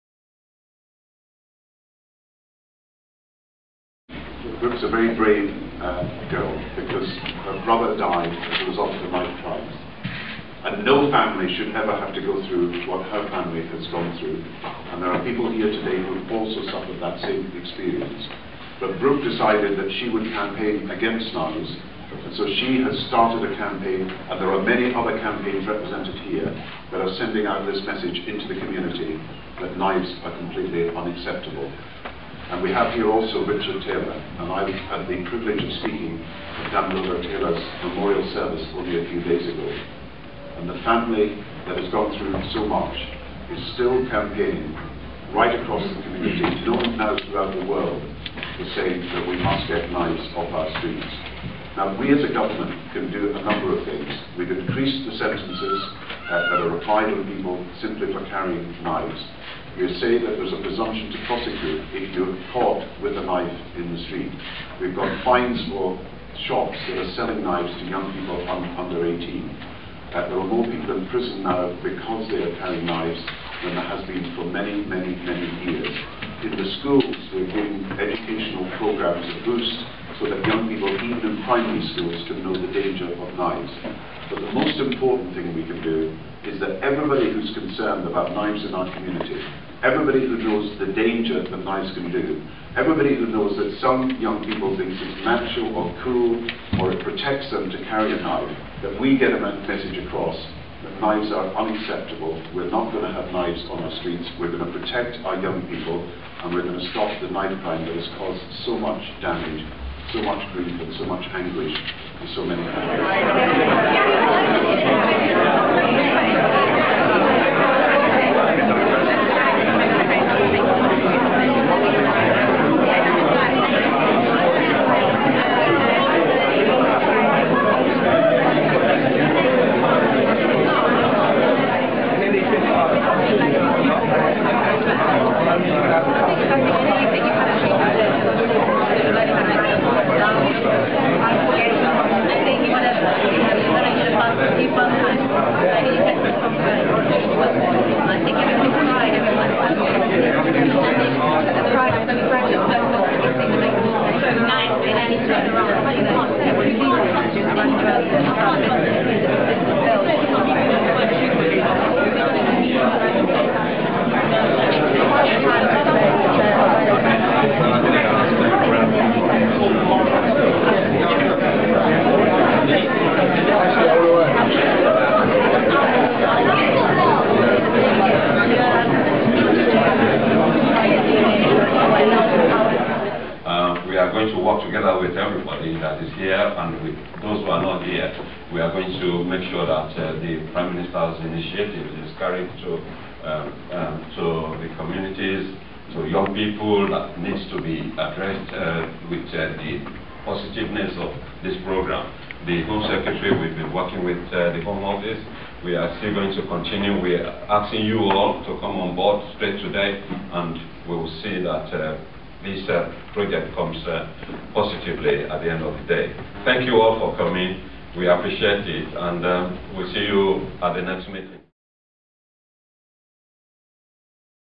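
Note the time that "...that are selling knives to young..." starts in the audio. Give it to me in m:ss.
1:06.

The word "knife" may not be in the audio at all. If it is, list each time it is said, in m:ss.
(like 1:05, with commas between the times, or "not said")
0:09, 1:03, 1:38, 1:47.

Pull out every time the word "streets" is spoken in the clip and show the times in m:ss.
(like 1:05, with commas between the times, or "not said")
0:50, 1:04, 1:44.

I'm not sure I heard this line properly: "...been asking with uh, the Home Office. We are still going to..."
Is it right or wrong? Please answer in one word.
wrong.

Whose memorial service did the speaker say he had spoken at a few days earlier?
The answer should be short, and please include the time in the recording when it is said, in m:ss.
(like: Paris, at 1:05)
Damilola Taylor, at 0:36.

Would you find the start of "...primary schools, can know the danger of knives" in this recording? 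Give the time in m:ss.
1:21.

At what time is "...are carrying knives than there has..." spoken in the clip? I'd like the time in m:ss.
1:12.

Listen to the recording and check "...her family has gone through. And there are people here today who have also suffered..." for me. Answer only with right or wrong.
right.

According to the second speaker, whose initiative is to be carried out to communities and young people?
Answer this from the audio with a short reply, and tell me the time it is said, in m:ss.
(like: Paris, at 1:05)
The Prime Minister's, at 3:10.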